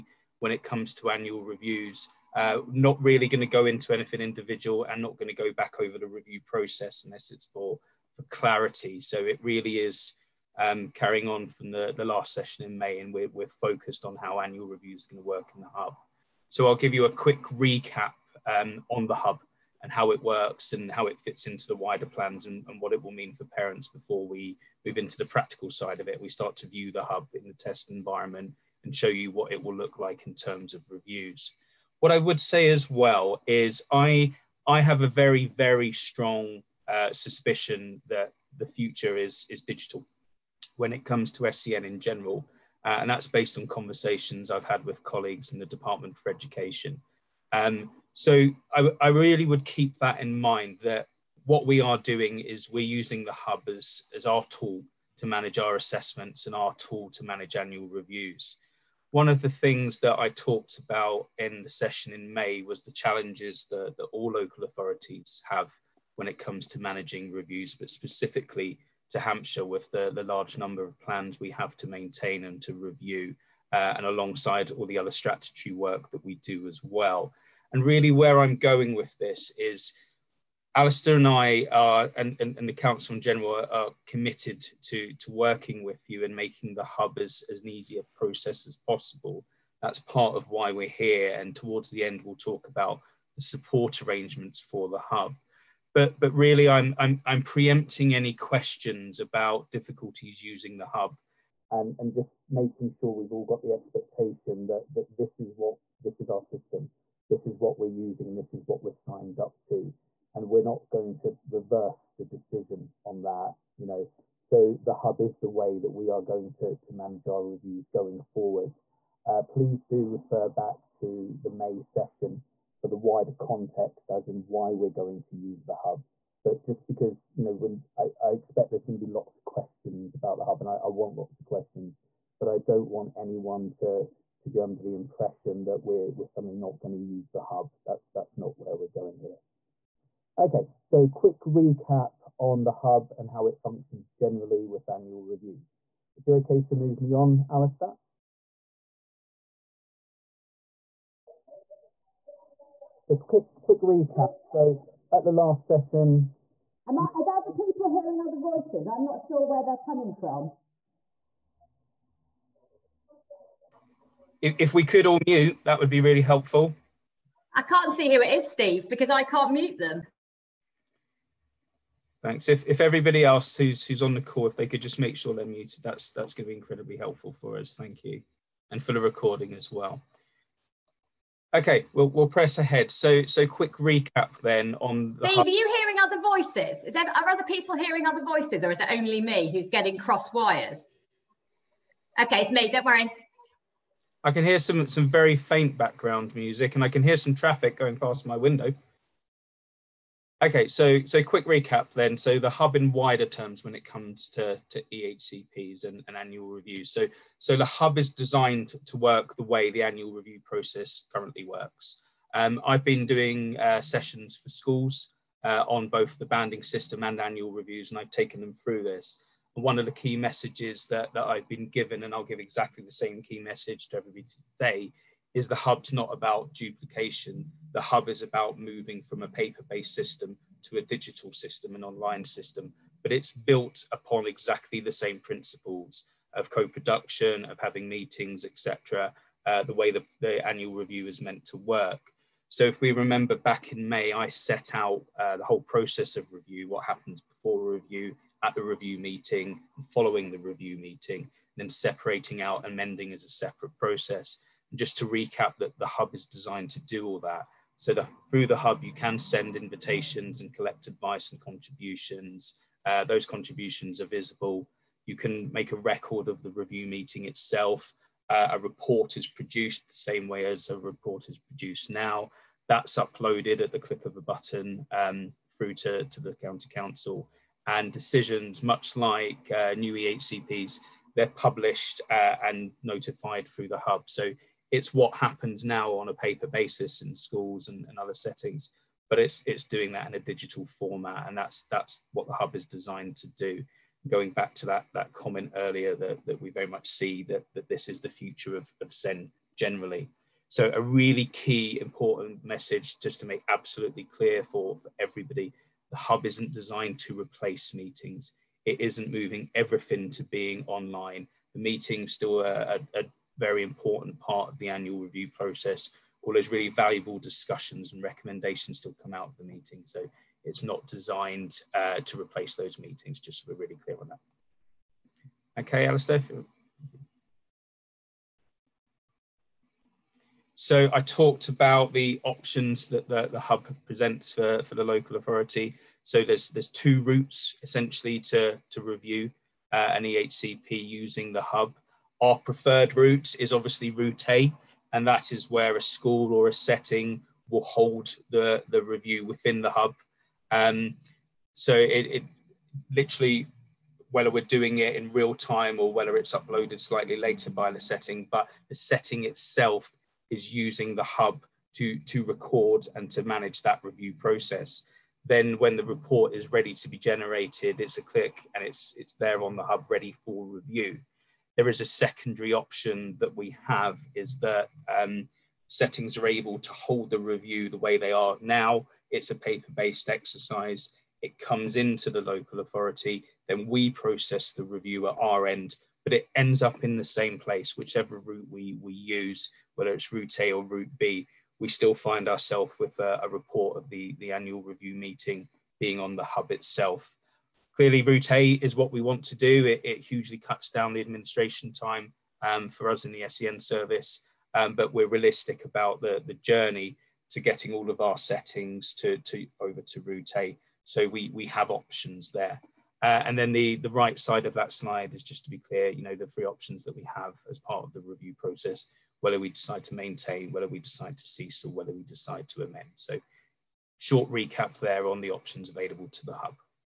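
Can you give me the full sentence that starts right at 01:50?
And we're not going to reverse the decision on that, you know.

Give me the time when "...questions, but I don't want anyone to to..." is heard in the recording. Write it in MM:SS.
02:11.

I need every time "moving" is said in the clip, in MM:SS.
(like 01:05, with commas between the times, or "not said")
03:48, 05:09.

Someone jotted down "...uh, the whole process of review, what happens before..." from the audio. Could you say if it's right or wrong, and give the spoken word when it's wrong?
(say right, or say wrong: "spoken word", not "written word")
right.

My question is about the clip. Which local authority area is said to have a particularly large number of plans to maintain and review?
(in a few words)
Hampshire.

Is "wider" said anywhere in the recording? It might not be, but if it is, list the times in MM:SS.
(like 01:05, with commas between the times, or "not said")
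00:21, 02:02, 03:22.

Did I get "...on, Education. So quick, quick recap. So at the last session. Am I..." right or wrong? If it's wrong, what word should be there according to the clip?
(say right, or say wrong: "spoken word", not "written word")
wrong: "Alistair", not "Education".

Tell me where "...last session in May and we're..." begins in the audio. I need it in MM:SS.
00:12.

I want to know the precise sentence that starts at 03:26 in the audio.
So so the hub is designed to work the way the annual review process currently works.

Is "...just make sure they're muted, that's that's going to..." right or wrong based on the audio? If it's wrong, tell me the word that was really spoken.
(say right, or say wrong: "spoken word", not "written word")
right.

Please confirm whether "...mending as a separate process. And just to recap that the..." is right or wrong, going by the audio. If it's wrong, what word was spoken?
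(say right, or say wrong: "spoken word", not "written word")
right.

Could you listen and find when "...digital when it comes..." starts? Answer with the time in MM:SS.
00:39.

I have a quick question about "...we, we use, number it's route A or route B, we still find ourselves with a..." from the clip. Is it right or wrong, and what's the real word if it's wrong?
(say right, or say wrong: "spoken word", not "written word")
wrong: "whether", not "number".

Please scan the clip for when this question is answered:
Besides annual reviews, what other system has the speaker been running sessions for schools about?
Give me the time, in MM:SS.
03:36.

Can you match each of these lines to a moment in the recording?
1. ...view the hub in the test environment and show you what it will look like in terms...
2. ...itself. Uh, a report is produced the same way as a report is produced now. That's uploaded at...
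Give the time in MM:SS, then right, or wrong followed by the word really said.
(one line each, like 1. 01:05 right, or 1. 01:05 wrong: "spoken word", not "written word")
1. 00:26 right
2. 04:27 right.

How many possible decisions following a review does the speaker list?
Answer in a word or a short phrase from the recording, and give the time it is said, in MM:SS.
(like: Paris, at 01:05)
3, at 06:56.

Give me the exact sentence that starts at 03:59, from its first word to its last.
Uh, the way the, the annual review is meant to work.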